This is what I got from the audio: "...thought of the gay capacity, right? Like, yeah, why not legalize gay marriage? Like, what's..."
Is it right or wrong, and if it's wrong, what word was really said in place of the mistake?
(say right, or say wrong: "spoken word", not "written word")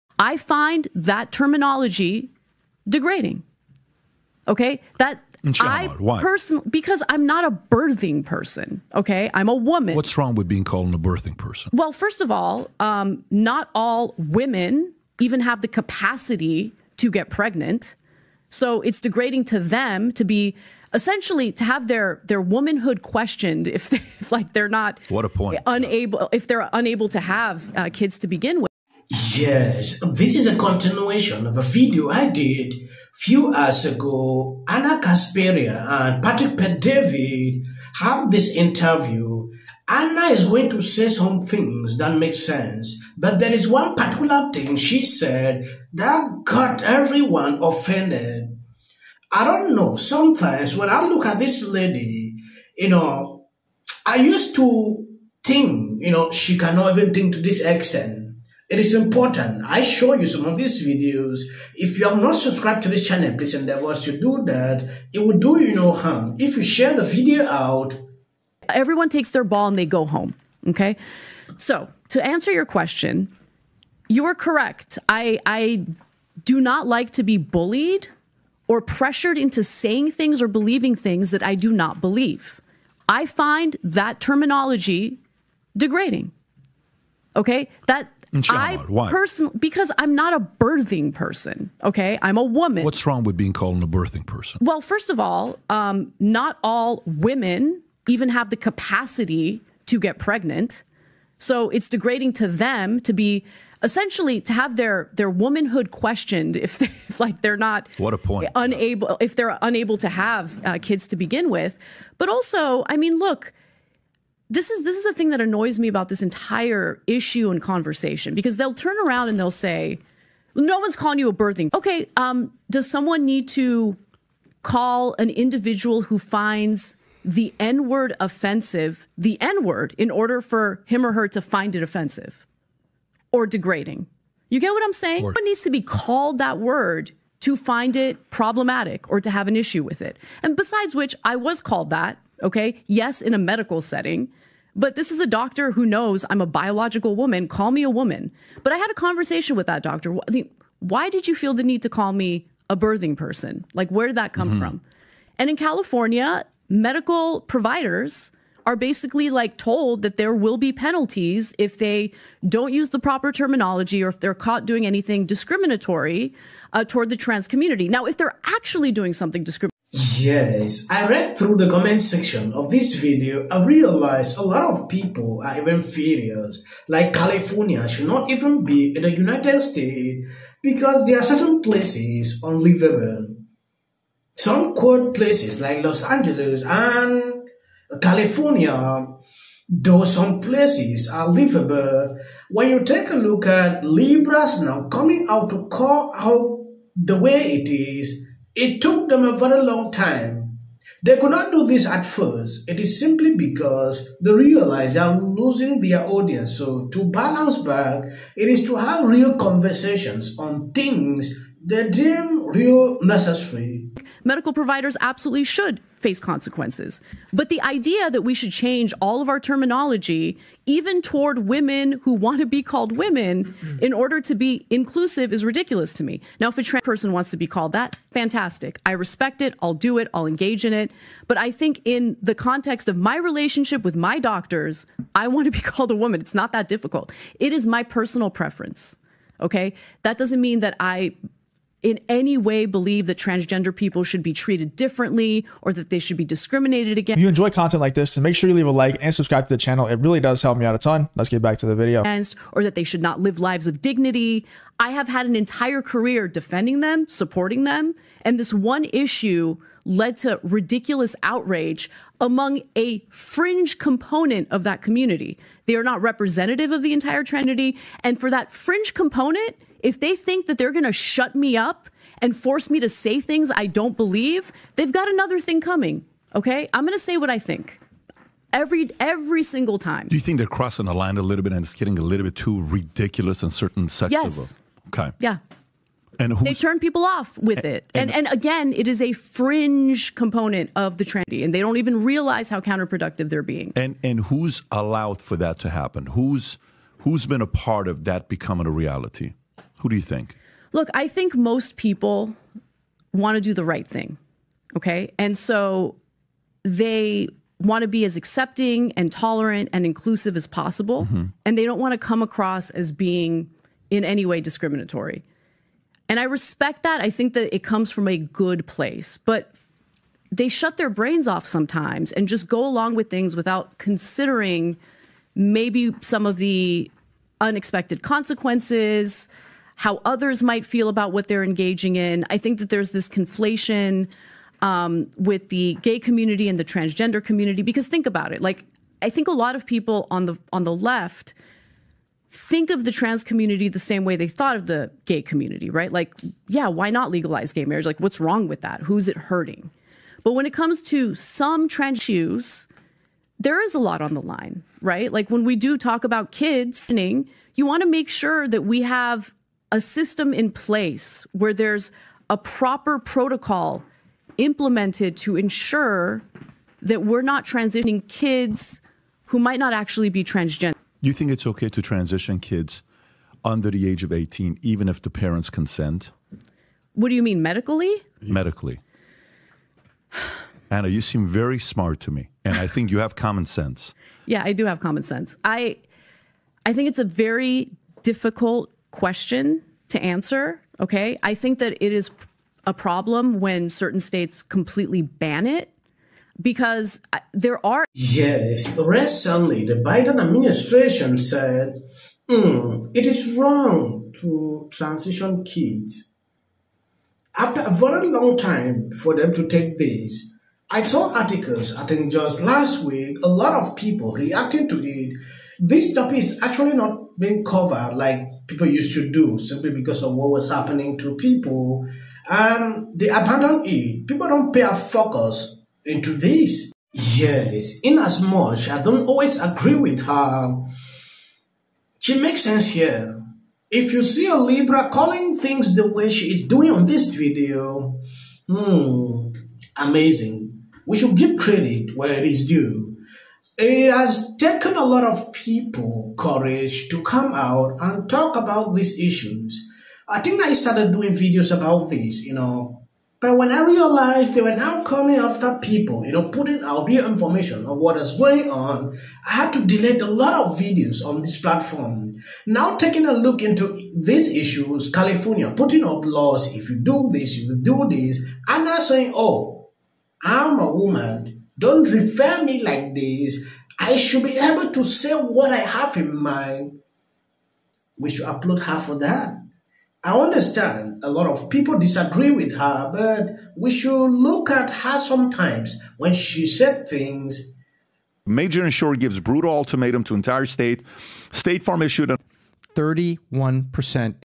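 wrong: "community", not "capacity".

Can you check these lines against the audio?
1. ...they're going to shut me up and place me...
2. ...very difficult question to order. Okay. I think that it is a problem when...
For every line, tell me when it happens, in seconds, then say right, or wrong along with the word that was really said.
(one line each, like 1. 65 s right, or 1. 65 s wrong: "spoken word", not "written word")
1. 270 s wrong: "force", not "place"
2. 387 s wrong: "answer", not "order".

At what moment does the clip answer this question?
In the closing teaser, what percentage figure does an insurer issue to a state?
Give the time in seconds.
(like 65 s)
492 s.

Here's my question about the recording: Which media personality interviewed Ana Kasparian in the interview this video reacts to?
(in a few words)
Patrick Bet-David.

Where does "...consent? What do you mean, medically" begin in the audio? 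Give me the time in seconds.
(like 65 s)
375 s.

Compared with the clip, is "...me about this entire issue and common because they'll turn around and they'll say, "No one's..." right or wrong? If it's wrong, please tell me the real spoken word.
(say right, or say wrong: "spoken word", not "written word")
wrong: "conversation", not "common".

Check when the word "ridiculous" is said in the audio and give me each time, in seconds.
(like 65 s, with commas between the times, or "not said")
225 s, 260 s, 282 s.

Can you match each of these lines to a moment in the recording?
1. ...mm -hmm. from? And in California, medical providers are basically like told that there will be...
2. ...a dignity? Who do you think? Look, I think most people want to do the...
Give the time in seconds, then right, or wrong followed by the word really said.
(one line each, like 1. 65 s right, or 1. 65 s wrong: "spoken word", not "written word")
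1. 154 s right
2. 298 s wrong: "reality", not "dignity".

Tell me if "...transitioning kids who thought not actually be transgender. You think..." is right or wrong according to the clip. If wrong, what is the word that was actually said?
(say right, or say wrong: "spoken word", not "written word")
wrong: "might", not "thought".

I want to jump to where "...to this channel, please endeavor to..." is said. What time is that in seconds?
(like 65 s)
62 s.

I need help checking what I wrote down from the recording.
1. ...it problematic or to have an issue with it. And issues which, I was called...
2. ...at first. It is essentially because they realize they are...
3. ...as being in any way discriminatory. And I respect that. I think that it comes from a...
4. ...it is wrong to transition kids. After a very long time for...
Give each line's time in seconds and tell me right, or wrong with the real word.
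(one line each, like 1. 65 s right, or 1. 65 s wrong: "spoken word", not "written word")
1. 137 s wrong: "besides", not "issues"
2. 201 s wrong: "simply", not "essentially"
3. 312 s right
4. 402 s right.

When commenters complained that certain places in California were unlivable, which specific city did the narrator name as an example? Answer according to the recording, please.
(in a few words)
Los Angeles.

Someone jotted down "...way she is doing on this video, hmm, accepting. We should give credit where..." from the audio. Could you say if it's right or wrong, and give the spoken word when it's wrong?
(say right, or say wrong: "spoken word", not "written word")
wrong: "amazing", not "accepting".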